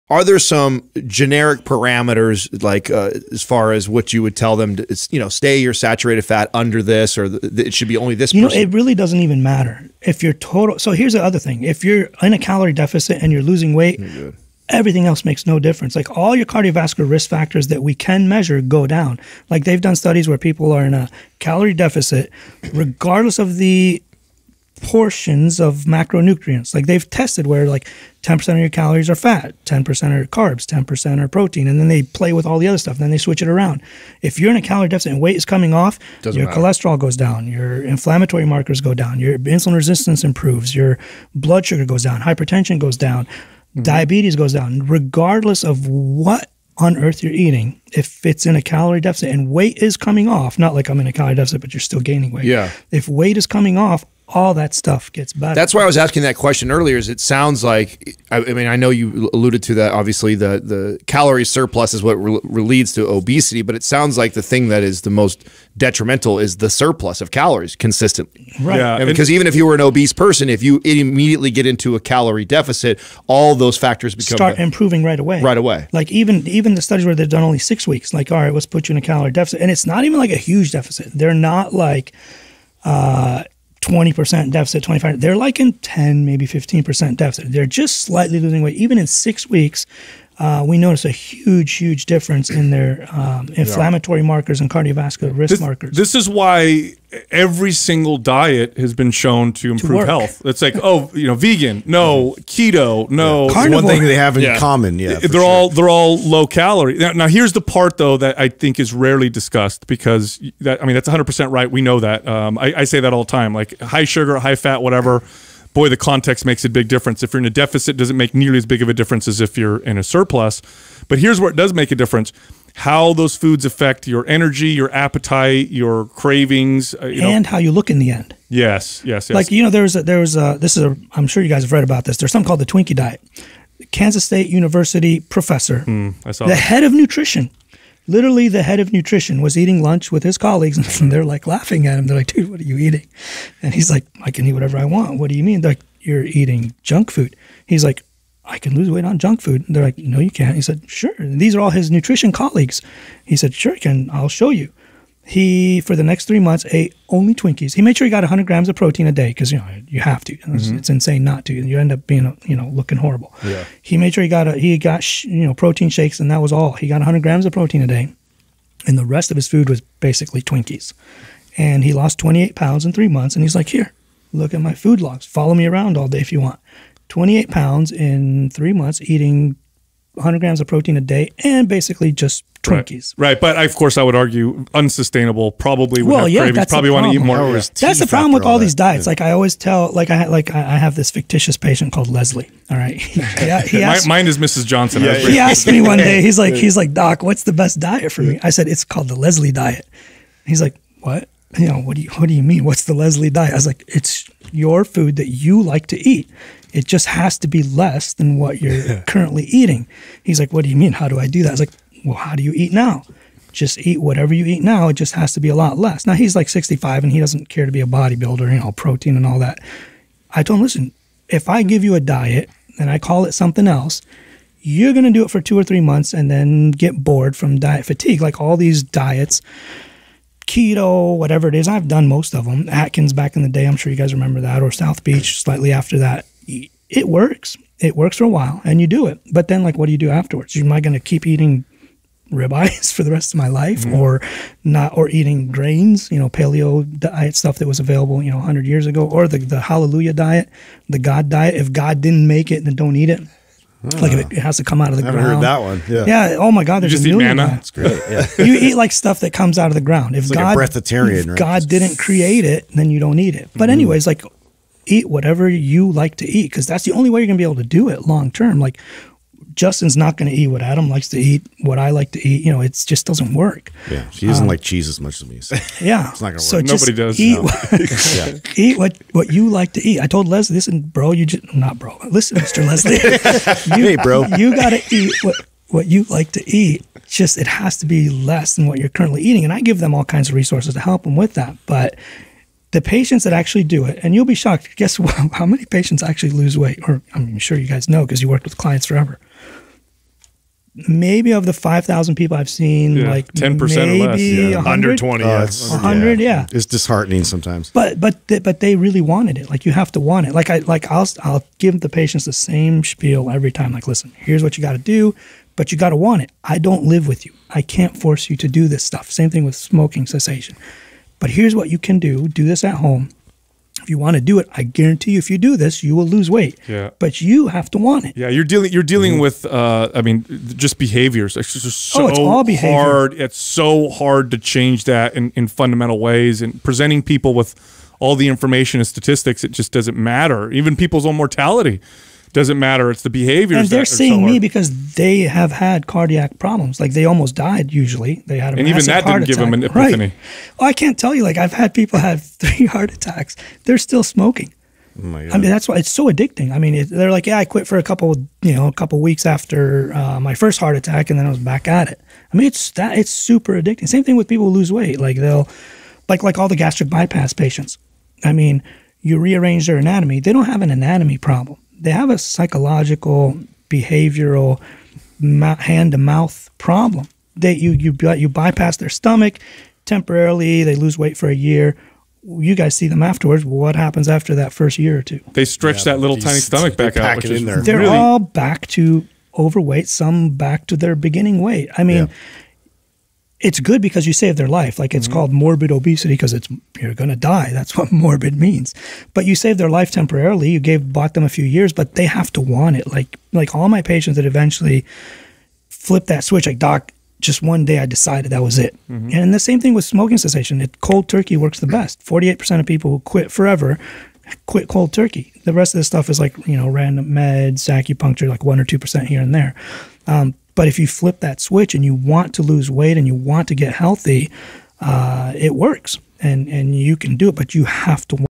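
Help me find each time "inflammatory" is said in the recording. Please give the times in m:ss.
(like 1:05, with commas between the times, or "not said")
0:37, 1:33.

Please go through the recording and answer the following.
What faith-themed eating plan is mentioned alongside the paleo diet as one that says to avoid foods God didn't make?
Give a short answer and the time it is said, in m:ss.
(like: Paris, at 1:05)
Hallelujah diet, at 4:09.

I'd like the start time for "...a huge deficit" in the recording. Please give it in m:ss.
1:20.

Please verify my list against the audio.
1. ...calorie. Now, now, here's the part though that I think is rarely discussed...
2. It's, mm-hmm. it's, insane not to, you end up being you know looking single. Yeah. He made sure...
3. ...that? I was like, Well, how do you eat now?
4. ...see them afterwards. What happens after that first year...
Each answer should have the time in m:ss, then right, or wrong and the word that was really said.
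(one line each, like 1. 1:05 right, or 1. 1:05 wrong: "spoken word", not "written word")
1. 1:46 right
2. 2:40 wrong: "horrible", not "single"
3. 3:31 right
4. 6:22 right.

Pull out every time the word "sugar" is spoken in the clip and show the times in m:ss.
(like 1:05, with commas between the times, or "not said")
0:41, 1:54.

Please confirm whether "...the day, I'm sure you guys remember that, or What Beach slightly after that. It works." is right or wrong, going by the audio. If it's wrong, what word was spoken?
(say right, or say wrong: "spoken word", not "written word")
wrong: "South", not "What".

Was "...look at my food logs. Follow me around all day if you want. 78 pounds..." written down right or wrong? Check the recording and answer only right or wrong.
wrong.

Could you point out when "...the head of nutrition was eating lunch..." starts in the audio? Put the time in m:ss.
2:18.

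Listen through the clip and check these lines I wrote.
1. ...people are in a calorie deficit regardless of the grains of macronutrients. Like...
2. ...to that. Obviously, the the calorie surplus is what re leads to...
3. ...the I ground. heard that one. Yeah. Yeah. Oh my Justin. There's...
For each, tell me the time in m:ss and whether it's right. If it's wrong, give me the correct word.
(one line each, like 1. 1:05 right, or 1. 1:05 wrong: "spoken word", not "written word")
1. 0:20 wrong: "portions", not "grains"
2. 0:59 right
3. 4:15 wrong: "God", not "Justin".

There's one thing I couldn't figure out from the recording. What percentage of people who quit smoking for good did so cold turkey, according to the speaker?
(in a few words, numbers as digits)
48%.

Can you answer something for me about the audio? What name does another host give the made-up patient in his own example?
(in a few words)
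Mrs. Johnson.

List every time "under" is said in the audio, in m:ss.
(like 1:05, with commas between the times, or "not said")
0:06, 5:04.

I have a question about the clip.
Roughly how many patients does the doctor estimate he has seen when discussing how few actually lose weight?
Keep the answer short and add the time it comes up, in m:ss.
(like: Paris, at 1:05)
5,000, at 5:01.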